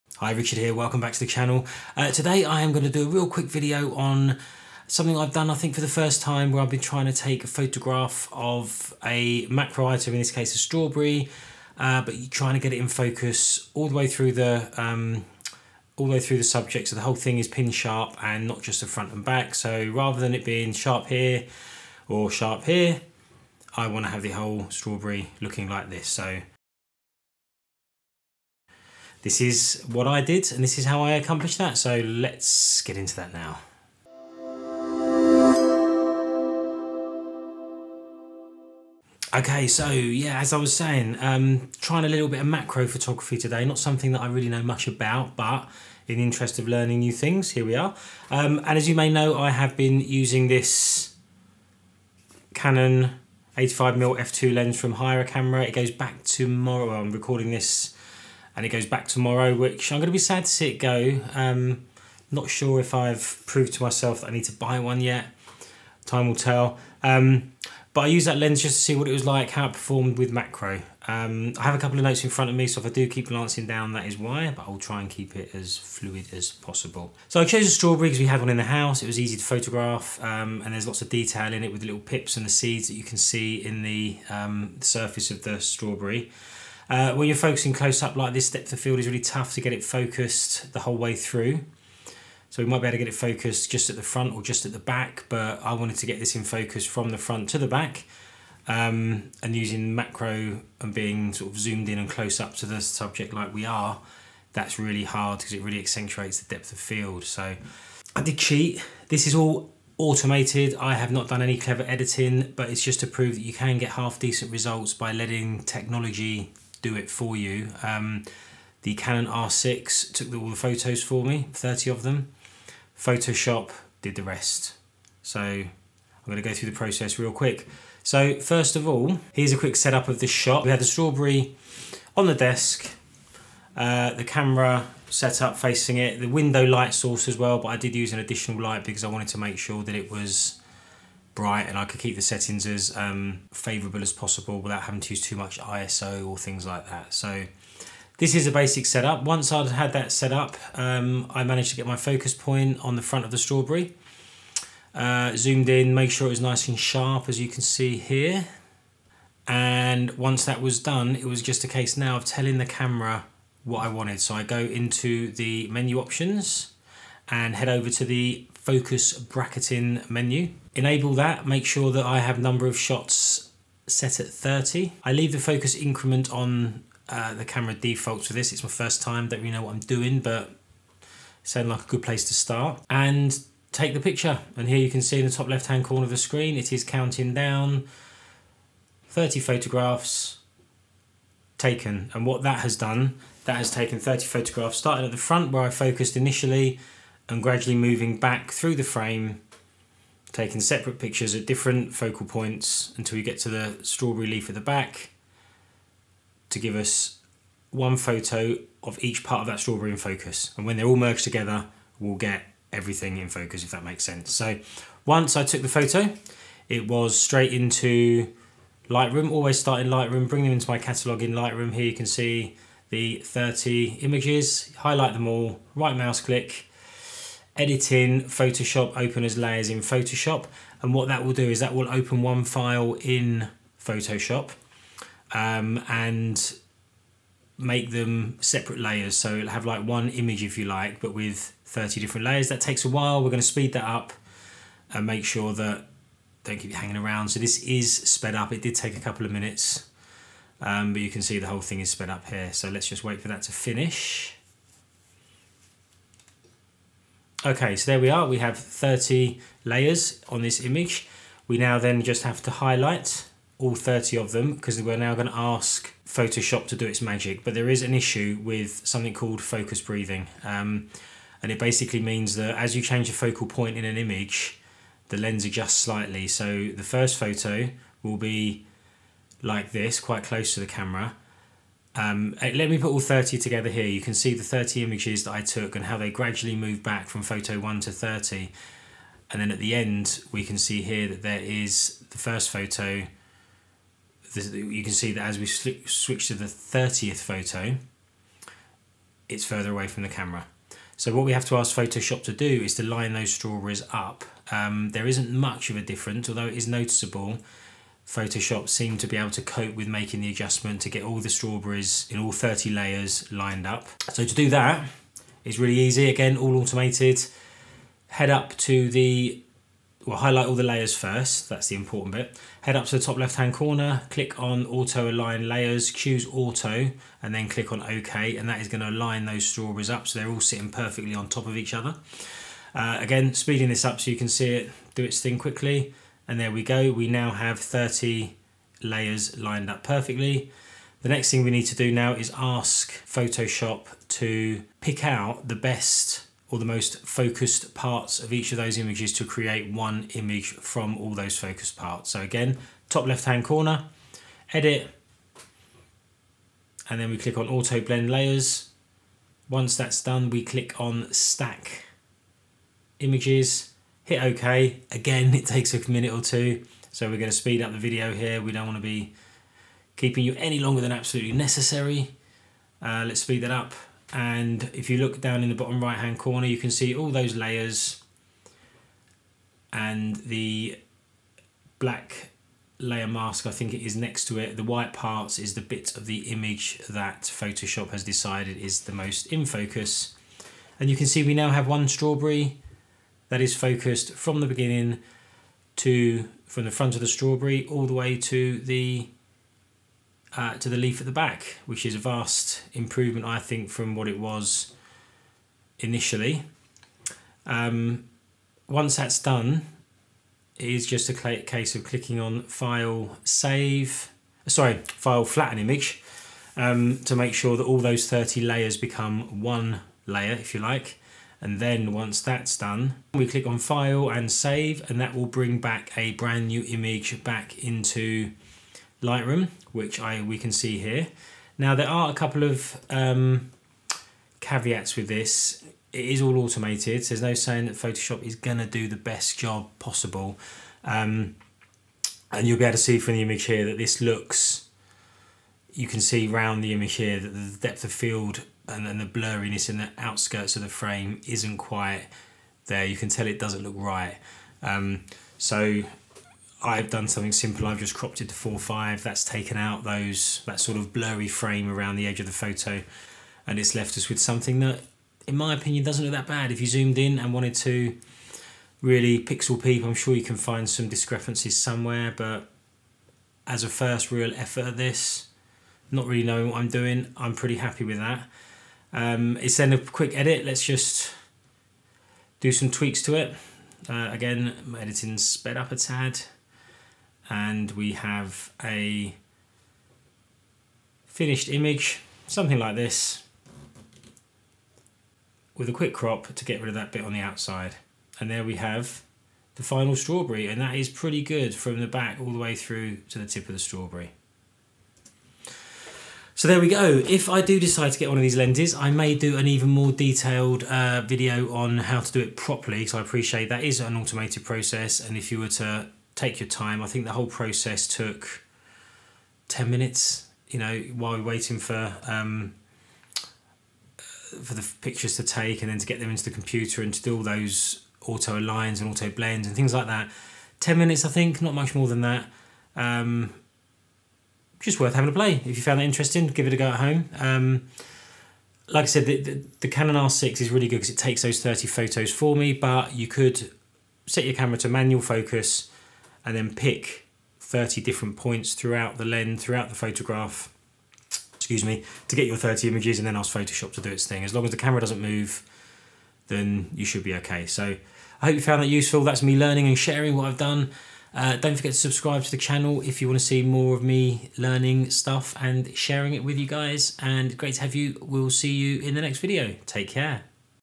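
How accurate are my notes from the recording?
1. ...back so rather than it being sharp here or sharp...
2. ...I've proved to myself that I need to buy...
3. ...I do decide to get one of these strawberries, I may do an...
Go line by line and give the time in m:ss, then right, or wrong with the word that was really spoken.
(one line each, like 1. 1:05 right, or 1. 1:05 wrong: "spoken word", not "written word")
1. 0:19 right
2. 1:02 right
3. 8:27 wrong: "lenses", not "strawberries".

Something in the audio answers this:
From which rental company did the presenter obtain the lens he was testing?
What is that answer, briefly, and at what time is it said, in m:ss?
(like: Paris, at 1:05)
Hireacamera, at 0:54.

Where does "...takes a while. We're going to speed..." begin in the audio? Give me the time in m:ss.
4:02.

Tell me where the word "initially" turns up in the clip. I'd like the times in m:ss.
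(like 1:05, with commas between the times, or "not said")
3:16, 6:45.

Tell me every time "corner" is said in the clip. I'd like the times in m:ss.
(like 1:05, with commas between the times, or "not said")
3:05, 5:23, 5:53, 6:16.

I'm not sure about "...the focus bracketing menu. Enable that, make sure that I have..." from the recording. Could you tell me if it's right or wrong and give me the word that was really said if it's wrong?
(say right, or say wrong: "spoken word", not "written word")
right.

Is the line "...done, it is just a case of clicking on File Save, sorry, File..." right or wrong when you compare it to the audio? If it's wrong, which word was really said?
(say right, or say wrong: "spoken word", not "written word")
right.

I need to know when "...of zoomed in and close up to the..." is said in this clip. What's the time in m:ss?
1:41.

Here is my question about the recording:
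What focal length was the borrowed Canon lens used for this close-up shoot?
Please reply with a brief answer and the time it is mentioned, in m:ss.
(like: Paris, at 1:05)
85mm, at 0:53.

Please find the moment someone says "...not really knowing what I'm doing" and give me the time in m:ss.
7:55.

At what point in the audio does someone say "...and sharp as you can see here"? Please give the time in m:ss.
2:36.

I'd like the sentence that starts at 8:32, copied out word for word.
So I appreciate that is an automated process.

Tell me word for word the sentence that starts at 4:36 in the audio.
So the first photo will be like this, quite close to the camera.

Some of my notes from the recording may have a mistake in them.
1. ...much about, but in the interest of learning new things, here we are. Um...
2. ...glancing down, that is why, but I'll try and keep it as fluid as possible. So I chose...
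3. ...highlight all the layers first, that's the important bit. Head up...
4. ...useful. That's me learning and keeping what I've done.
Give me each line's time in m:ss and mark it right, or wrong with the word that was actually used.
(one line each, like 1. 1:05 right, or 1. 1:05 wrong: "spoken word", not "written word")
1. 0:44 right
2. 1:13 right
3. 5:20 right
4. 9:18 wrong: "sharing", not "keeping".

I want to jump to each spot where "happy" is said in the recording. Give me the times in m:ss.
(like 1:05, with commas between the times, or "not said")
7:57.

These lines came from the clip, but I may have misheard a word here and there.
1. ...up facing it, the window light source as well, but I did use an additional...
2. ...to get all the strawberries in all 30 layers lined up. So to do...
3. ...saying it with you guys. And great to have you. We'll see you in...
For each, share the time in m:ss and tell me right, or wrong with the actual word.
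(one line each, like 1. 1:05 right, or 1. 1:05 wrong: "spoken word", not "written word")
1. 2:15 right
2. 5:10 right
3. 9:25 wrong: "sharing", not "saying".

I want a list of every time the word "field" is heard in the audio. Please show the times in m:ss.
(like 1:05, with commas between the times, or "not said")
1:28, 1:46, 7:27.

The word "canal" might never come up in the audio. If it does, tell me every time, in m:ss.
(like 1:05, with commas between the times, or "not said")
not said.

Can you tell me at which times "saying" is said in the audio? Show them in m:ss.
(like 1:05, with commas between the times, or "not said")
0:40, 7:17.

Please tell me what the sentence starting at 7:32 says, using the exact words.
You can tell it doesn't look right.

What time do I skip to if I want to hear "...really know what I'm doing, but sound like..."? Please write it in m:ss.
2:59.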